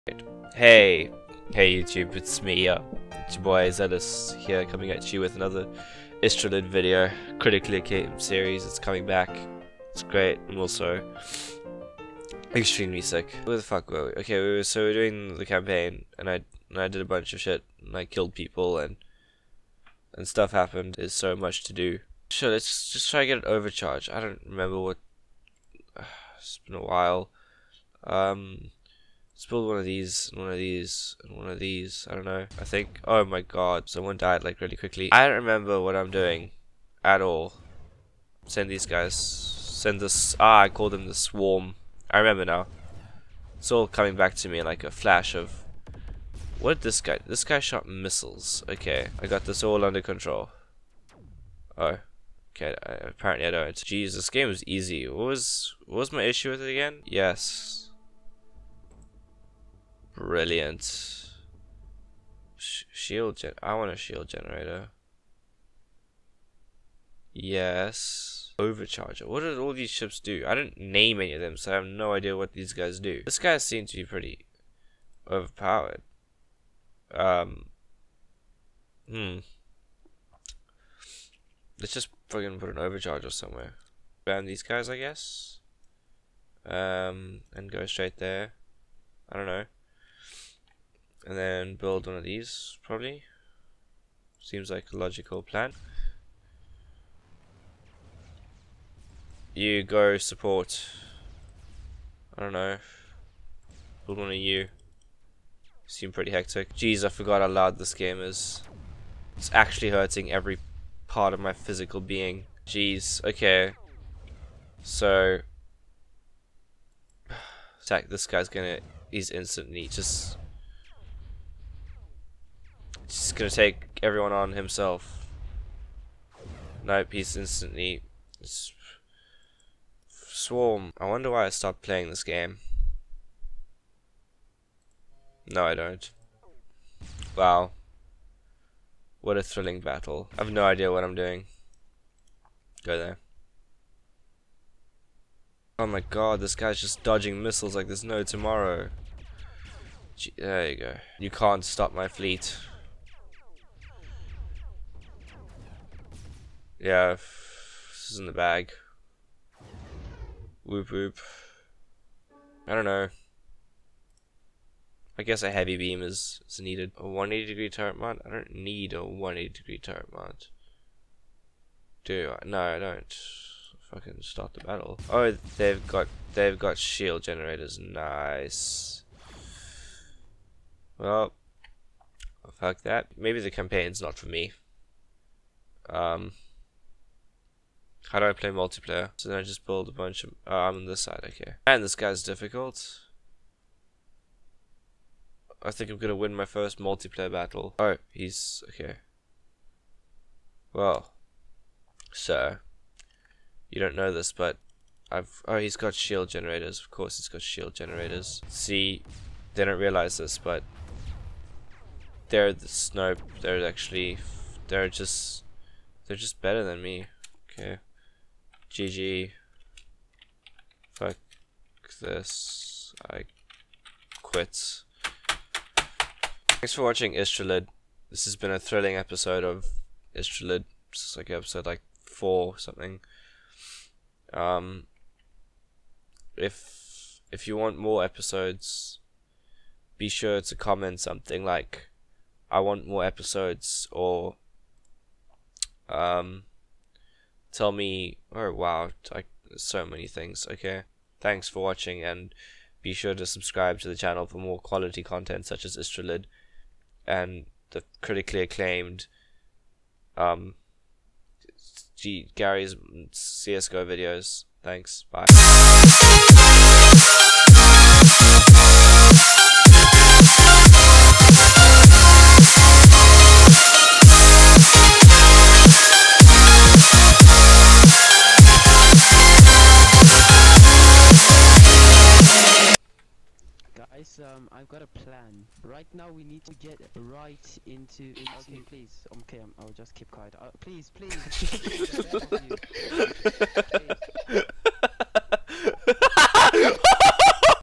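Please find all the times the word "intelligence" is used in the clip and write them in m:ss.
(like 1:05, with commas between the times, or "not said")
not said.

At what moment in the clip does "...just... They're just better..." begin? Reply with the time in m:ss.
3:34.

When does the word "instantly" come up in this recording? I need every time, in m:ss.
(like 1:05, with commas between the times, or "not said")
1:59, 2:07.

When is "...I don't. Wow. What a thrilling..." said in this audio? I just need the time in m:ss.
2:15.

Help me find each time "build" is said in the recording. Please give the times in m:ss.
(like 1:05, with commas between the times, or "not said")
0:29, 1:31, 1:44, 3:09.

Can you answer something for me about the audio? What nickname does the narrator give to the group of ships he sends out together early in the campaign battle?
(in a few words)
The swarm.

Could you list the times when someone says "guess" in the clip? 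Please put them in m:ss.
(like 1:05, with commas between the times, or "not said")
1:24, 2:45.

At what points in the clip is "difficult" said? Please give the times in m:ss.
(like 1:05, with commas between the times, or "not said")
3:12.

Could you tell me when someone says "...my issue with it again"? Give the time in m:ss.
0:56.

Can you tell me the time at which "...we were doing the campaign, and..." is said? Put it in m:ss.
0:14.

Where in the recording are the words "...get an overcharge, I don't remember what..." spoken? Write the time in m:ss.
0:23.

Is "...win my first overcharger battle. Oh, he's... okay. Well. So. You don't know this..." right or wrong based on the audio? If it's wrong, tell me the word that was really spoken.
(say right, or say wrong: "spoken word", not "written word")
wrong: "multiplayer", not "overcharger".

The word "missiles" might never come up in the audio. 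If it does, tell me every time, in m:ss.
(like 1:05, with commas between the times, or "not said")
0:47, 2:27.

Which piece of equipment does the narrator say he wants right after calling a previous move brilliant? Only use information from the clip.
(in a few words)
Shield generator.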